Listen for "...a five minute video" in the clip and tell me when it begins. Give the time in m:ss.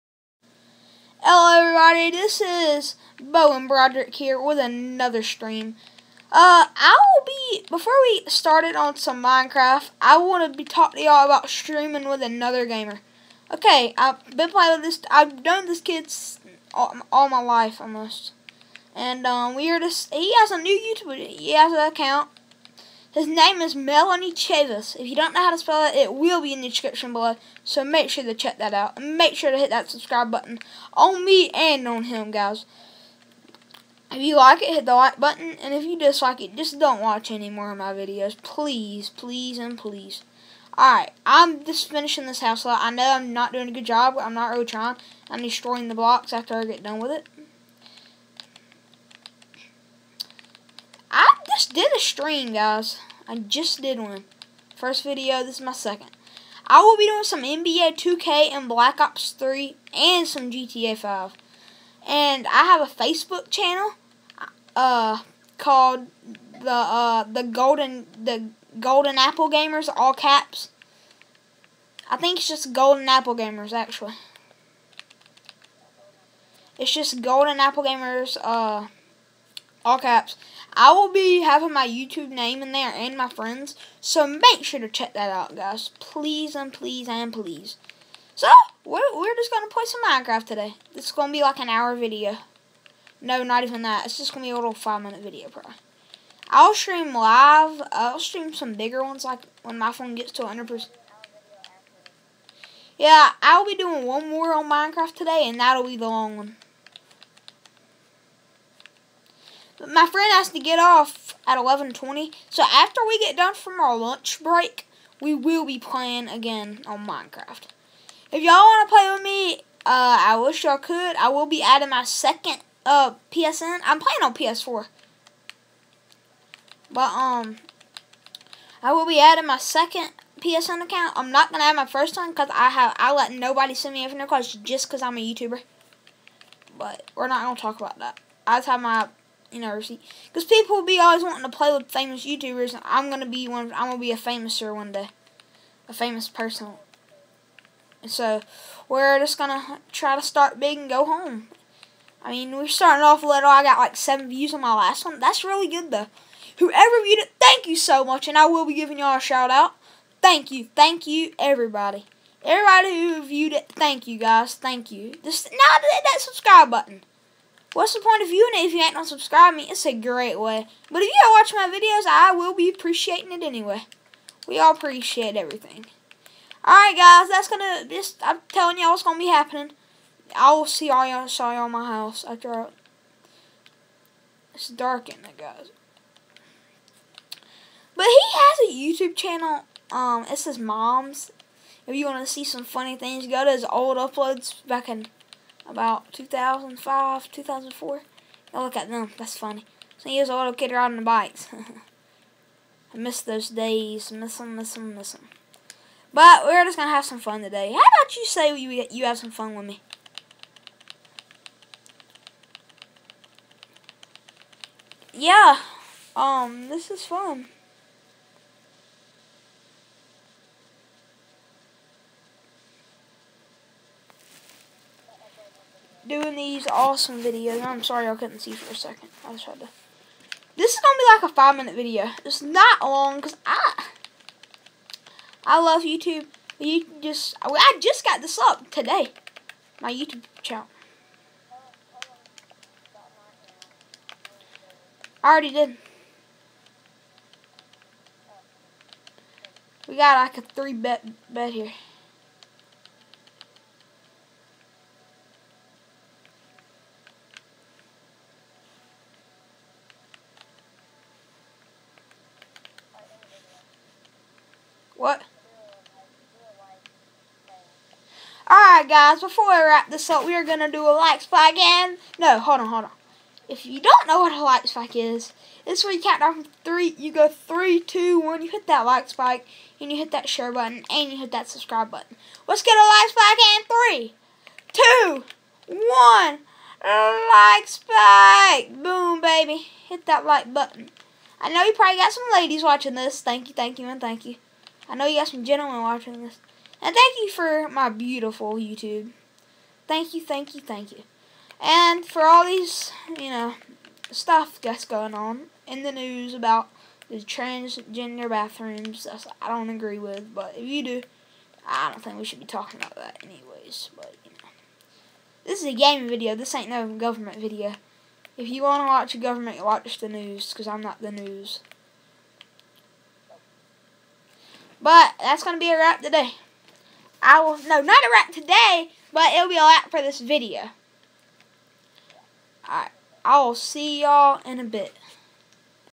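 3:51.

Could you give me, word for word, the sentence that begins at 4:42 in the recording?
Let's get a like spike and three, two, one, like spike!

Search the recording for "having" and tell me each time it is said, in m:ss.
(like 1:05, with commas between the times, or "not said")
1:21.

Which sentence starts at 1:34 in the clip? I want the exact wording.
It's just going to be a little five-minute video, probably.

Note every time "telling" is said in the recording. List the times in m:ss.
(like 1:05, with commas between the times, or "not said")
2:58.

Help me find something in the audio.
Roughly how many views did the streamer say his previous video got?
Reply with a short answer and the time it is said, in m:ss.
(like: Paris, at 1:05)
7, at 2:33.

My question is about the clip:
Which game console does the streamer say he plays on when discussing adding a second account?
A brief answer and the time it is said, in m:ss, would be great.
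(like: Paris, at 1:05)
PS4, at 2:04.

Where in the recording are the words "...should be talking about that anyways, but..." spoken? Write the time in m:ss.
5:12.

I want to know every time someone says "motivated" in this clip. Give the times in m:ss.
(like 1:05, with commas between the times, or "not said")
not said.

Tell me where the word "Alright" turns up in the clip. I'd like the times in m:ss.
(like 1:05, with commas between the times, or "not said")
0:40, 2:56, 4:28, 5:32.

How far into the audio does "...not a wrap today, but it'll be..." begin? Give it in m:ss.
5:27.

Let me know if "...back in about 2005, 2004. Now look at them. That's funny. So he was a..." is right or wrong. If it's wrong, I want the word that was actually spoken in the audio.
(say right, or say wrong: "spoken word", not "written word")
right.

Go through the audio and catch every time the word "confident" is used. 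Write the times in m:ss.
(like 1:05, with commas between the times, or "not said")
not said.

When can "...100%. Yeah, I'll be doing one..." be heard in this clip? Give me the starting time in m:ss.
1:40.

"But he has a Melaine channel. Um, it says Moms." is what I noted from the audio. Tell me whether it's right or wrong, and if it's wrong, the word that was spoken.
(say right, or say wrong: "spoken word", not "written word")
wrong: "YouTube", not "Melaine".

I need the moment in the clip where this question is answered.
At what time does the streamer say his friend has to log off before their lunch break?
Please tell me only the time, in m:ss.
1:51.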